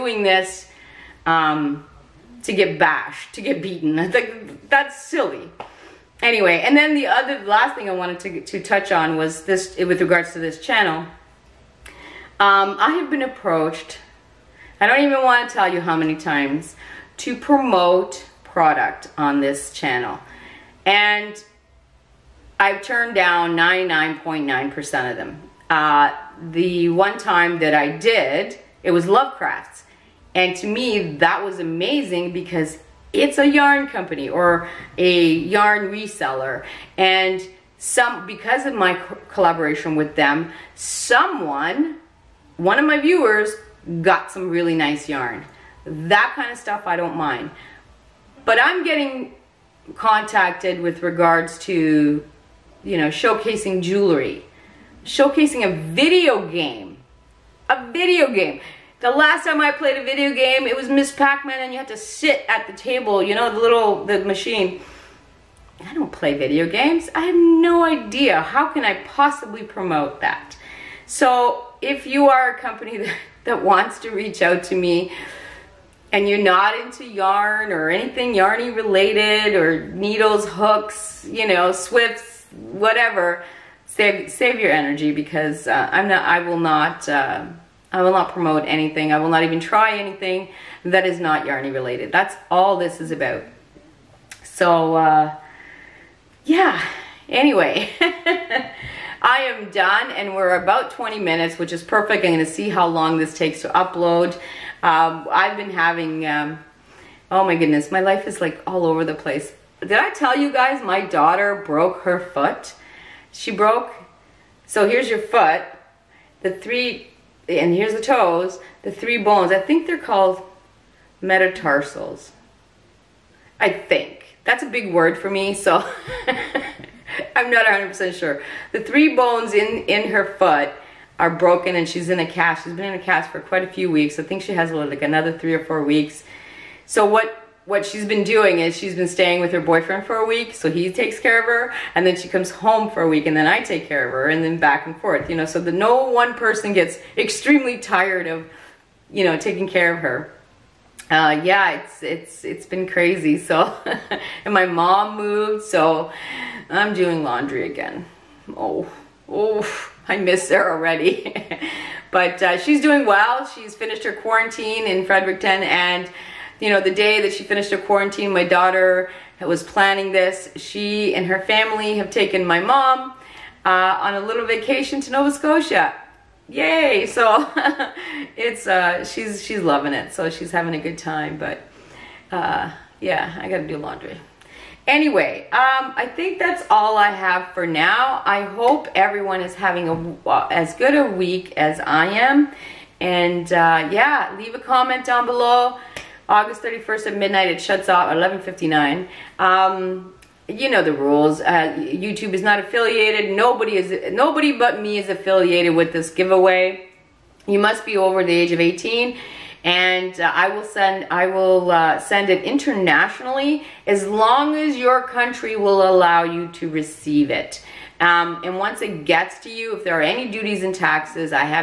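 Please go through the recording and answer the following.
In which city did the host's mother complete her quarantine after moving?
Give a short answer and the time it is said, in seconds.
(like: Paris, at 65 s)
Fredericton, at 165 s.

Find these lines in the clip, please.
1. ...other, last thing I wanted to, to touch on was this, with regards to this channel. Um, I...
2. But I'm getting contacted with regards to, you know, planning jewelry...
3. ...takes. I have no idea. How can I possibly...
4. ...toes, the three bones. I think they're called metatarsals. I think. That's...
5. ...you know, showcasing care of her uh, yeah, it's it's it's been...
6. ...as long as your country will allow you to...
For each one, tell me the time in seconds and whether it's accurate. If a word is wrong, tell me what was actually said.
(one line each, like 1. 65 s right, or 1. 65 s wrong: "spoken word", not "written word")
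1. 7 s right
2. 48 s wrong: "showcasing", not "planning"
3. 66 s wrong: "games", not "takes"
4. 118 s right
5. 149 s wrong: "taking", not "showcasing"
6. 213 s right.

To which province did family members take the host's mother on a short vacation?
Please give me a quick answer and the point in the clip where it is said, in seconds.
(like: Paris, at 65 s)
Nova Scotia, at 175 s.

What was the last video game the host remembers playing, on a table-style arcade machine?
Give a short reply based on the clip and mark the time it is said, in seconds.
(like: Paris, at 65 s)
Miss Pac-Man, at 60 s.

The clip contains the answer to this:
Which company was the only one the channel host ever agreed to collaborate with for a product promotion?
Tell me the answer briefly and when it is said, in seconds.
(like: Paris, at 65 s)
Lovecrafts, at 29 s.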